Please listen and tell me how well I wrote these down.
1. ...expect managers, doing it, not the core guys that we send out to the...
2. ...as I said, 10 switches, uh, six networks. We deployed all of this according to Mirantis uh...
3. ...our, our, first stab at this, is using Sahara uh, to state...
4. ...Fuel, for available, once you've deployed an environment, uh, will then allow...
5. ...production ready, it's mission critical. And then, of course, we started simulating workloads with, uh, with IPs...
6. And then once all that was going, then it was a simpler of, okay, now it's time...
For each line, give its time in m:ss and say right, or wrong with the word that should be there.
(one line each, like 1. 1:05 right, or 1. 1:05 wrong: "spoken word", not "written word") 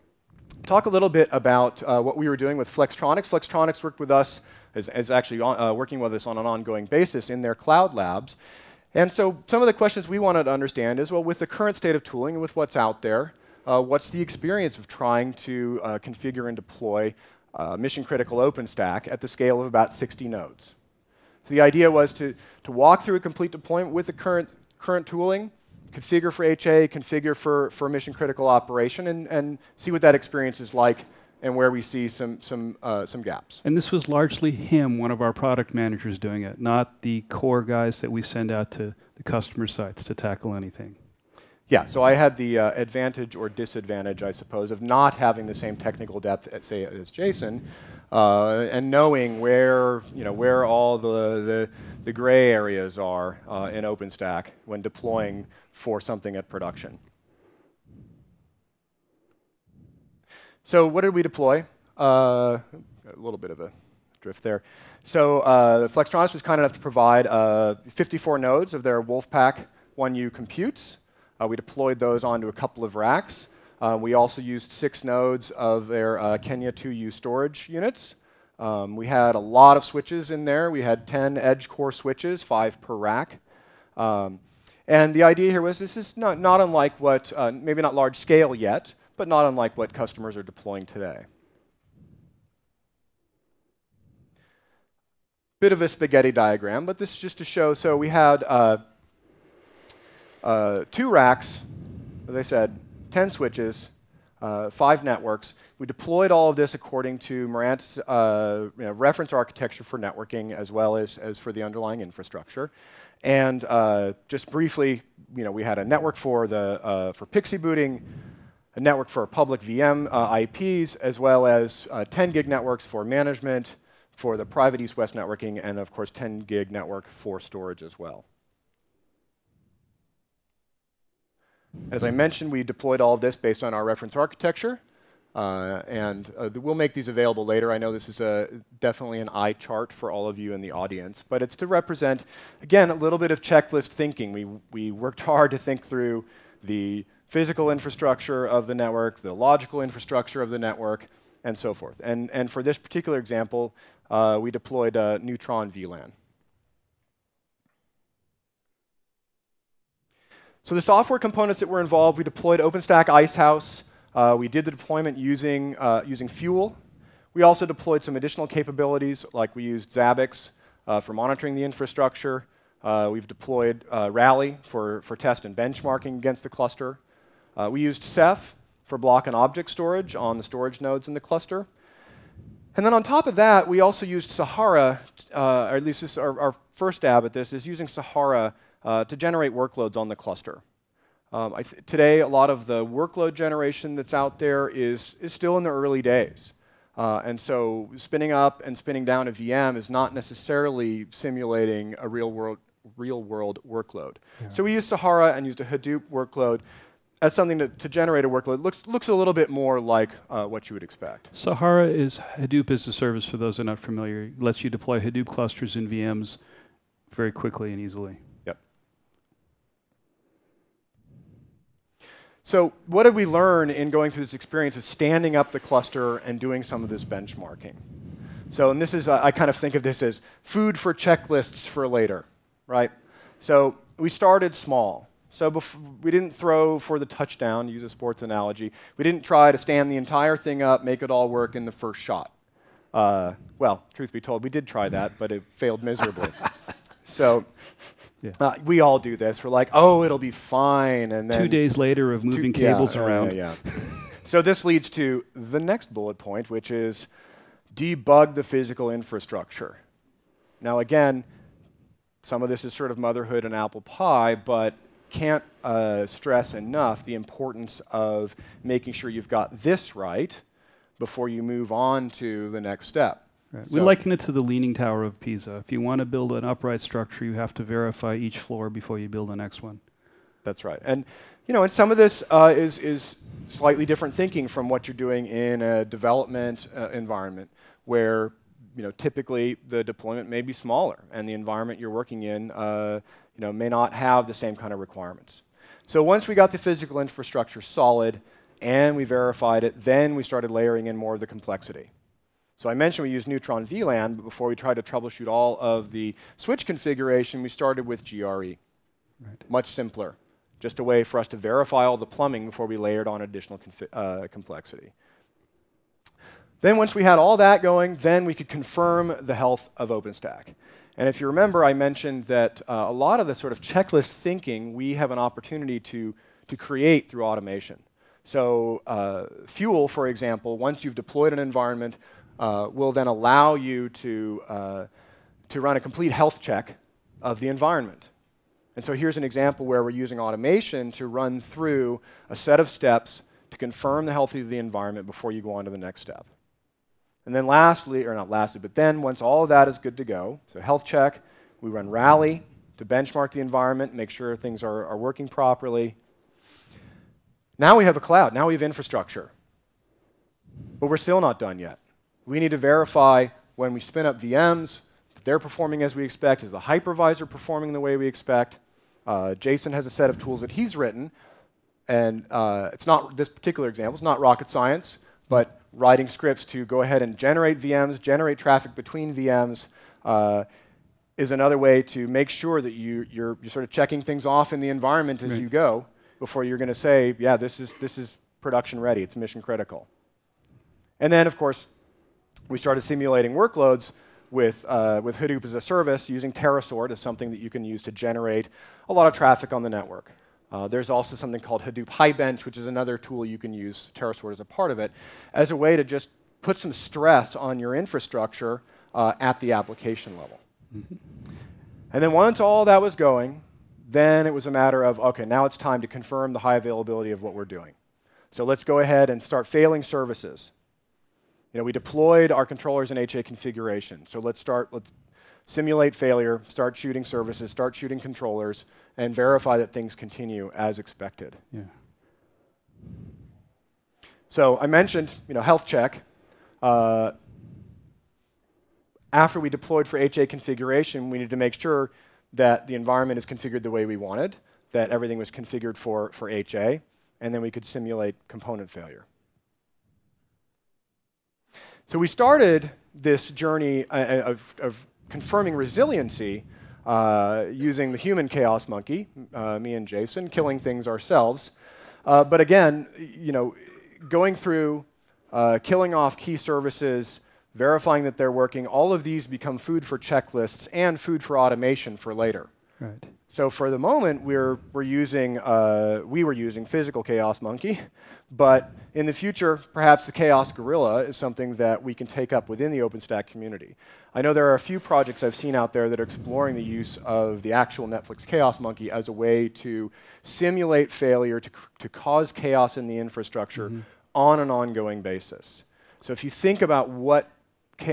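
1. 0:35 wrong: "product", not "expect"
2. 1:42 wrong: "five", not "six"
3. 3:06 wrong: "generate", not "state"
4. 5:29 wrong: "example", not "available"
5. 6:28 wrong: "Hadoop", not "IPs"
6. 6:51 wrong: "matter", not "simpler".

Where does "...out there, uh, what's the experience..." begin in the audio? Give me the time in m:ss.
0:12.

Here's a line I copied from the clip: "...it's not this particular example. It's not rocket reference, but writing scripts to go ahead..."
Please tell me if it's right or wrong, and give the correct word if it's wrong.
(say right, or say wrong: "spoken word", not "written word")
wrong: "science", not "reference".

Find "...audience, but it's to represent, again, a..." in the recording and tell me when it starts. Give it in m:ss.
2:20.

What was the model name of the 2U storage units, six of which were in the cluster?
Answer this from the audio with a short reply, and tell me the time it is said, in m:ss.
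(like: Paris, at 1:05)
Kenya, at 1:16.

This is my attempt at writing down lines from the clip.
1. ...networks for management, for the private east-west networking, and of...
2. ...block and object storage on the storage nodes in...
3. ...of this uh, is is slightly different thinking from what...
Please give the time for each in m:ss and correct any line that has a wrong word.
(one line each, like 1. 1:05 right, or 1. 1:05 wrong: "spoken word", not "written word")
1. 2:02 right
2. 2:58 right
3. 4:41 right.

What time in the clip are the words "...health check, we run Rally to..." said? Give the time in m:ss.
5:50.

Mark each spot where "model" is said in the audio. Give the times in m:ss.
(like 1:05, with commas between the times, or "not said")
not said.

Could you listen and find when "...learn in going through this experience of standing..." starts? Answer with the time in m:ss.
3:43.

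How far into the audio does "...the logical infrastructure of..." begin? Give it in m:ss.
2:29.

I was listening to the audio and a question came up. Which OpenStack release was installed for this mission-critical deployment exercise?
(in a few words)
Icehouse.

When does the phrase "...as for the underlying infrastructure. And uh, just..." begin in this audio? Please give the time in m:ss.
1:51.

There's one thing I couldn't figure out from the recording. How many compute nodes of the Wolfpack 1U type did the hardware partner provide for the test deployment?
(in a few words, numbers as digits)
54.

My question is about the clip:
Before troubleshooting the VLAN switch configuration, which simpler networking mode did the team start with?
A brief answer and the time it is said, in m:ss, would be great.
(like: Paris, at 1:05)
GRE, at 5:08.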